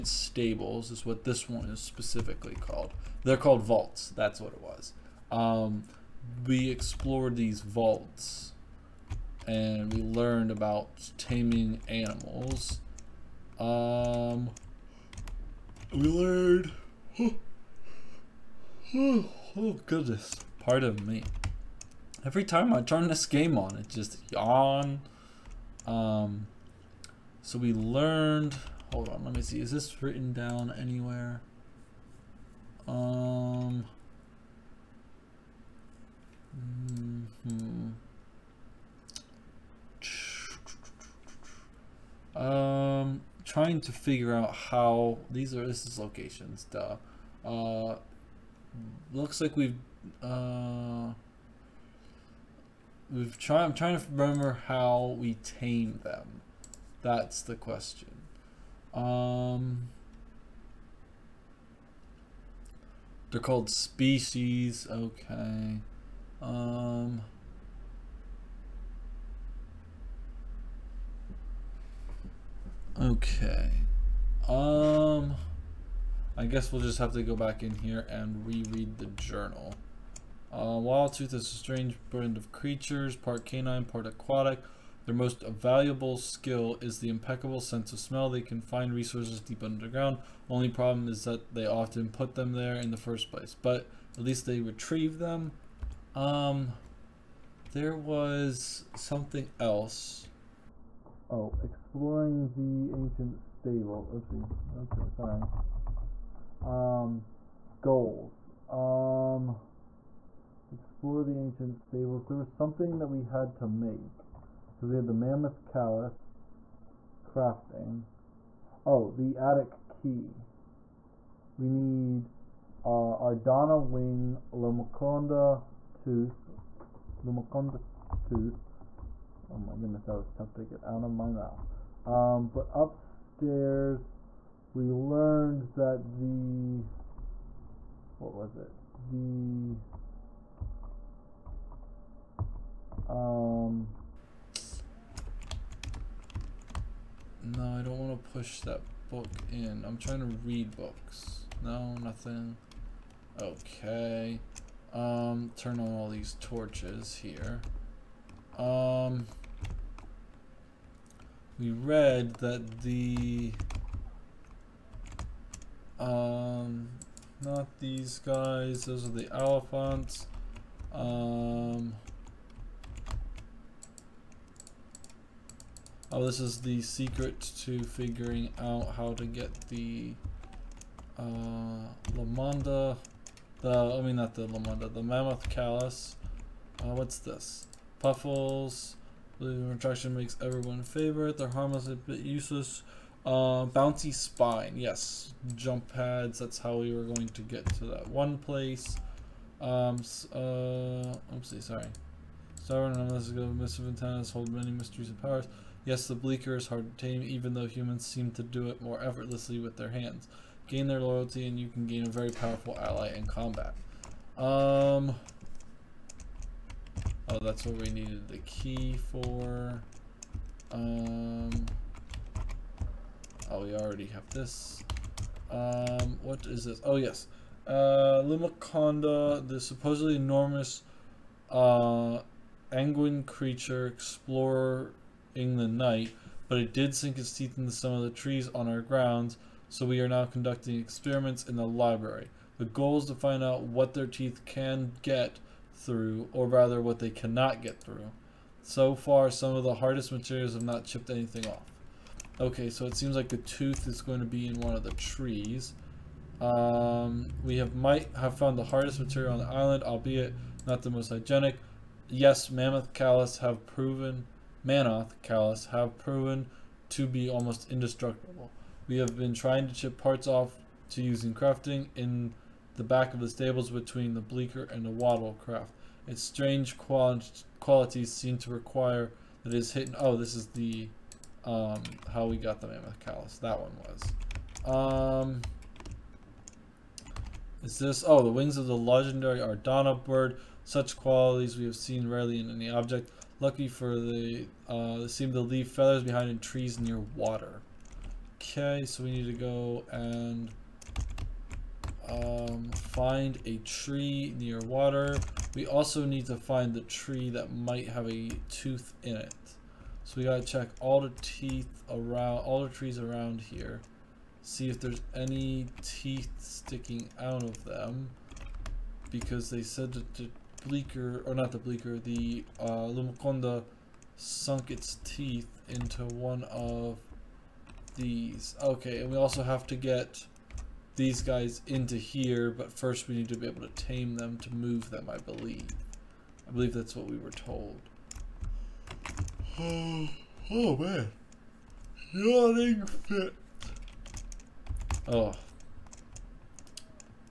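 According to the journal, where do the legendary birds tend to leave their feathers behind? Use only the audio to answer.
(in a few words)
In trees near water.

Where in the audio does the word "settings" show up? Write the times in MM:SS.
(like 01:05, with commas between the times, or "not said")
not said.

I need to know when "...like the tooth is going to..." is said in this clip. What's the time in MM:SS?
04:13.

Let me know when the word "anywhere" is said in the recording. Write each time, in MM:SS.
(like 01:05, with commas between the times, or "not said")
00:30.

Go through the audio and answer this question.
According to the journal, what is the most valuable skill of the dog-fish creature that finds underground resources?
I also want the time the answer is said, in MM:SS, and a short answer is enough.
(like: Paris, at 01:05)
Sense of smell, at 01:27.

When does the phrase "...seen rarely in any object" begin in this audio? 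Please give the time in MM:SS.
04:51.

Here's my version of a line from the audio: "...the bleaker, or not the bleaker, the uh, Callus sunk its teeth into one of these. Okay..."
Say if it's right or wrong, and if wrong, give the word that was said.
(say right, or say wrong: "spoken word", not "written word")
wrong: "Lumaconda", not "Callus".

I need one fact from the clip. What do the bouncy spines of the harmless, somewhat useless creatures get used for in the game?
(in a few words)
Jump pads.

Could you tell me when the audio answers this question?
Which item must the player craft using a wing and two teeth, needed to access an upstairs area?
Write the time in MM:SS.
01:59.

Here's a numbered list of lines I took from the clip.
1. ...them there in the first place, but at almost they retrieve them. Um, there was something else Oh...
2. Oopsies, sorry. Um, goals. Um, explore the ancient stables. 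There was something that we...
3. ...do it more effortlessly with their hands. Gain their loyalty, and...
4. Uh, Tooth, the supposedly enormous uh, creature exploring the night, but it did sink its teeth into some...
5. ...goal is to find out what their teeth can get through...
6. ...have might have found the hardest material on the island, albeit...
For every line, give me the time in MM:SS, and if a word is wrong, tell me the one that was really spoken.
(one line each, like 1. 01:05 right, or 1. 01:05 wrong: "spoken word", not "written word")
1. 01:32 wrong: "least", not "almost"
2. 01:44 right
3. 03:28 right
4. 03:47 wrong: "Lumaconda", not "Tooth"
5. 04:02 right
6. 04:17 right.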